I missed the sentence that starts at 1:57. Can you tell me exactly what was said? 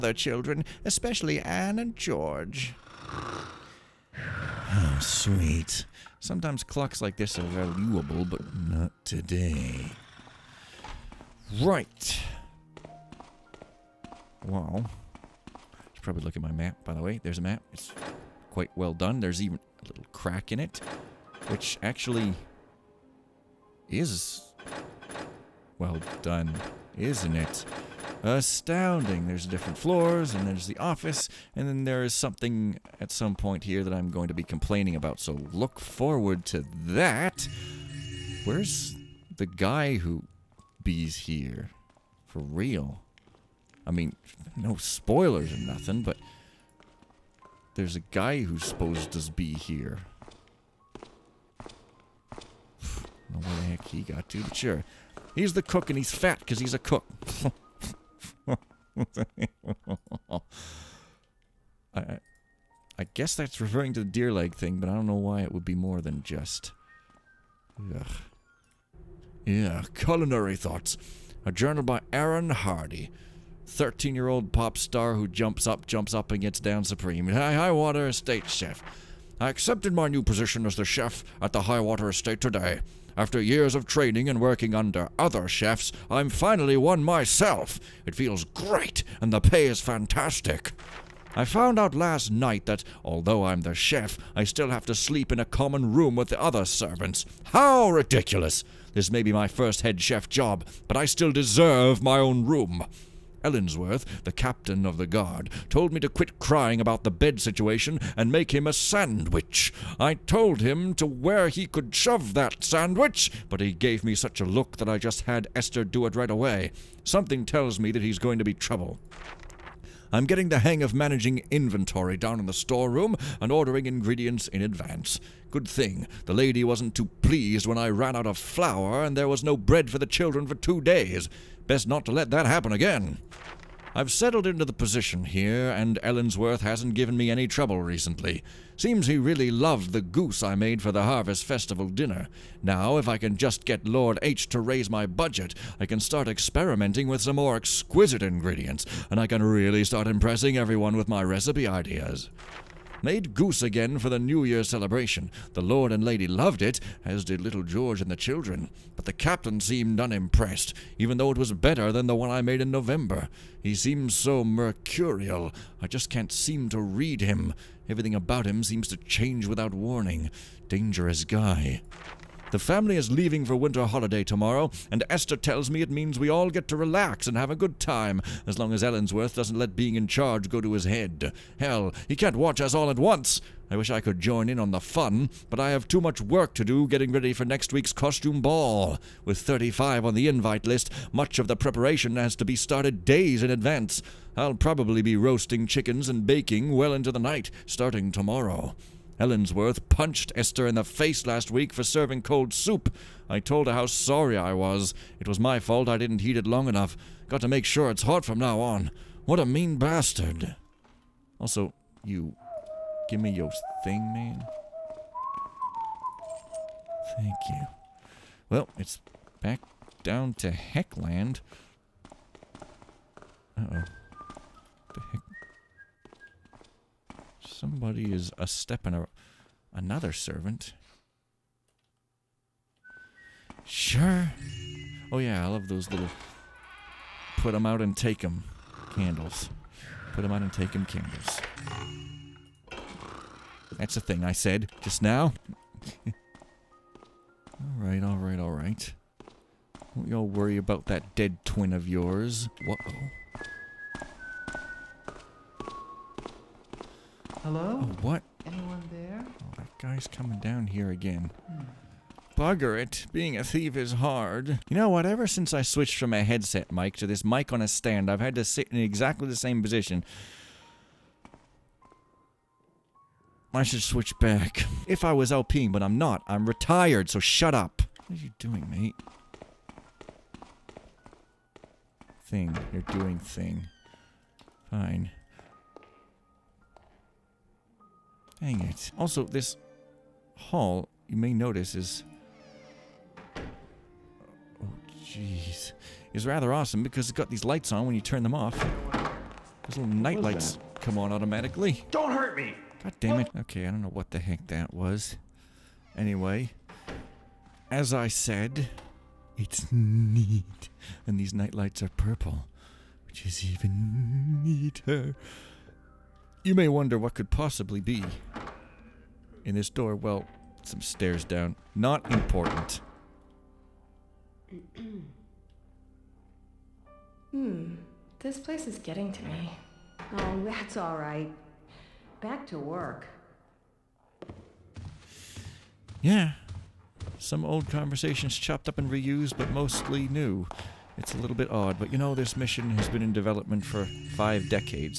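Something tells me that he's going to be trouble.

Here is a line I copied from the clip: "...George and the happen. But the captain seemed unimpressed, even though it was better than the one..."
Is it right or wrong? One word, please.
wrong.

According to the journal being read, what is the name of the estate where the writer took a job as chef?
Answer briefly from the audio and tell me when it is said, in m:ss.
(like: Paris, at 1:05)
Highwater Estate, at 1:21.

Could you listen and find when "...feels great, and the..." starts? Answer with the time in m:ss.
1:28.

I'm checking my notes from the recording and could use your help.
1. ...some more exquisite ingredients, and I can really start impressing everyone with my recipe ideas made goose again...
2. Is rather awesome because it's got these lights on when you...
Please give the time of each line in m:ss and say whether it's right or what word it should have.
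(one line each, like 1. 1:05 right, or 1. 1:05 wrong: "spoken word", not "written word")
1. 2:27 right
2. 4:56 right.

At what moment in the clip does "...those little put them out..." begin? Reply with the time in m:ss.
3:55.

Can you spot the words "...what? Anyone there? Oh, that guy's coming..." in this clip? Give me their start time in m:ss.
4:18.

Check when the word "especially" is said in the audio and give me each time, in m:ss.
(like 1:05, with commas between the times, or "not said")
0:00.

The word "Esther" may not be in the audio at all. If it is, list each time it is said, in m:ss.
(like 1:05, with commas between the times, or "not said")
1:55, 2:55, 3:20.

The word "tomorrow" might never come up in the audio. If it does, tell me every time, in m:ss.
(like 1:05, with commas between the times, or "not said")
2:54, 3:18.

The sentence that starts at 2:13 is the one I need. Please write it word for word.
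I've settled into the position here, and Ellensworth hasn't given me any trouble recently.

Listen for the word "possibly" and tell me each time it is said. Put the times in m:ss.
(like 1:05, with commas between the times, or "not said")
5:17.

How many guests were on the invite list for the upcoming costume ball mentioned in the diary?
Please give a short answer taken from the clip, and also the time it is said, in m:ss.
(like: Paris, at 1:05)
35, at 3:09.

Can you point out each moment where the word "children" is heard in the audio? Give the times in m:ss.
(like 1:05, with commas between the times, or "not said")
0:00, 2:10, 2:38.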